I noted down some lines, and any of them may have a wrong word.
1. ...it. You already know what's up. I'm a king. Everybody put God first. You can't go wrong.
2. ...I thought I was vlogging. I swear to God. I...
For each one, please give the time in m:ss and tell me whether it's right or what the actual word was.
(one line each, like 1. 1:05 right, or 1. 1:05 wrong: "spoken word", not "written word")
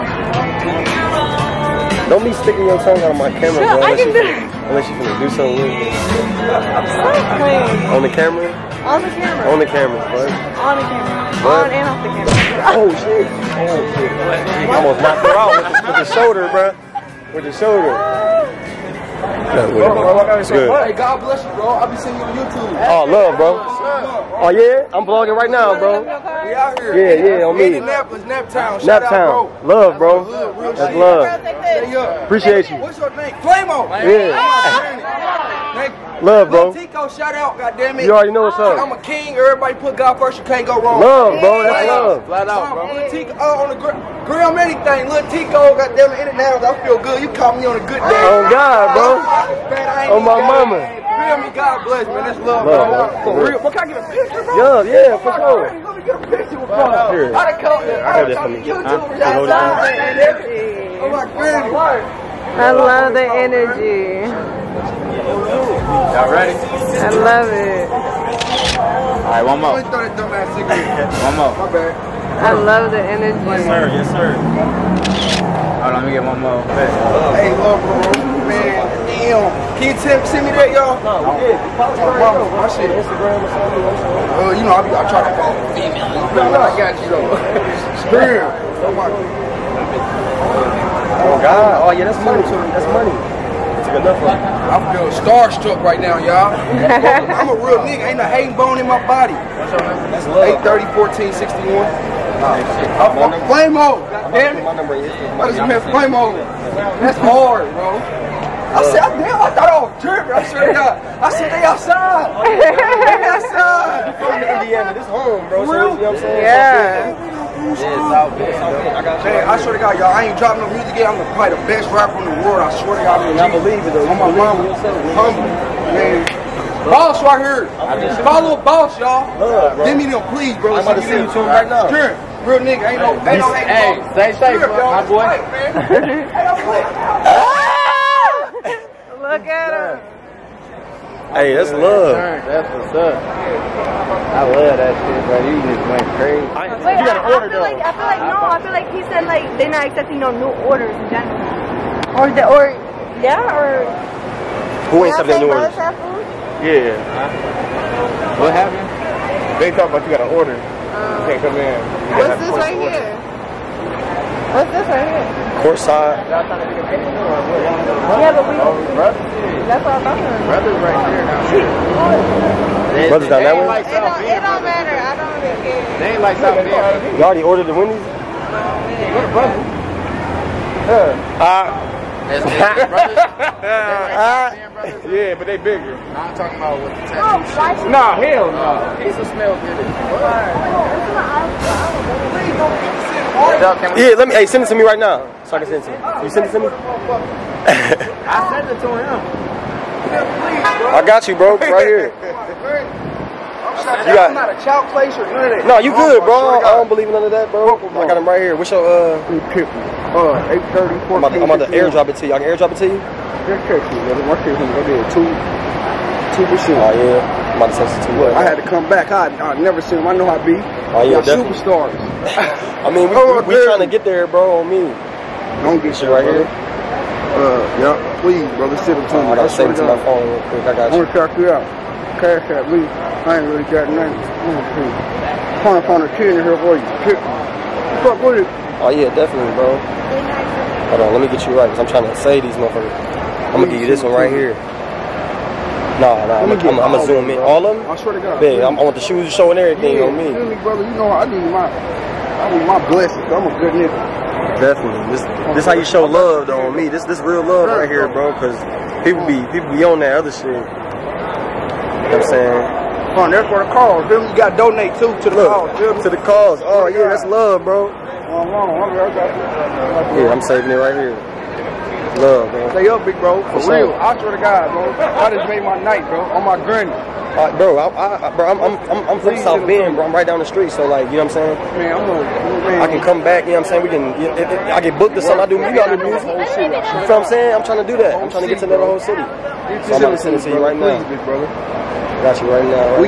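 1. 0:37 right
2. 1:49 wrong: "tripping", not "vlogging".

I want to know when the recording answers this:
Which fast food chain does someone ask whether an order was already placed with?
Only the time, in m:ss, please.
2:57.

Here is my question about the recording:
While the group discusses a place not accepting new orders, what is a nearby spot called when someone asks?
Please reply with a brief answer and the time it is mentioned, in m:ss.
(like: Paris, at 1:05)
Courtside, at 2:45.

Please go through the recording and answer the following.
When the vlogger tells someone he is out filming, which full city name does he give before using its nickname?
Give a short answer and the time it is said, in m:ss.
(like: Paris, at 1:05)
Indianapolis, at 0:27.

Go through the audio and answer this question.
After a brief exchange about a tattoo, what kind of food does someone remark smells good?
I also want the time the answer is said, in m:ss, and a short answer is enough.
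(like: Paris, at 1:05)
Pizza, at 3:09.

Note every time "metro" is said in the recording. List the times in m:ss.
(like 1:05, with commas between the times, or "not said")
not said.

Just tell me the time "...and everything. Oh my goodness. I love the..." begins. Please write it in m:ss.
0:59.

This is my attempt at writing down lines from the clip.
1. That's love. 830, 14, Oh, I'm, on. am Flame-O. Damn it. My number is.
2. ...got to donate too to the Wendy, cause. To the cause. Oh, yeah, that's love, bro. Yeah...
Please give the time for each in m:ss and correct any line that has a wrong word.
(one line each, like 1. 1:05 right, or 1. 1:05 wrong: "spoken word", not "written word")
1. 1:39 right
2. 4:24 wrong: "Look", not "Wendy".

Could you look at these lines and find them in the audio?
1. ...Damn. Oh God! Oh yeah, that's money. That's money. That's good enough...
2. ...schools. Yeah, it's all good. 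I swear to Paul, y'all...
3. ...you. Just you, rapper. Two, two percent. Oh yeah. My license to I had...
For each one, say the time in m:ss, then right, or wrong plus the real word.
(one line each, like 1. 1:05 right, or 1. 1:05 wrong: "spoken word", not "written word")
1. 1:28 right
2. 1:57 wrong: "God", not "Paul"
3. 3:32 wrong: "brother", not "rapper".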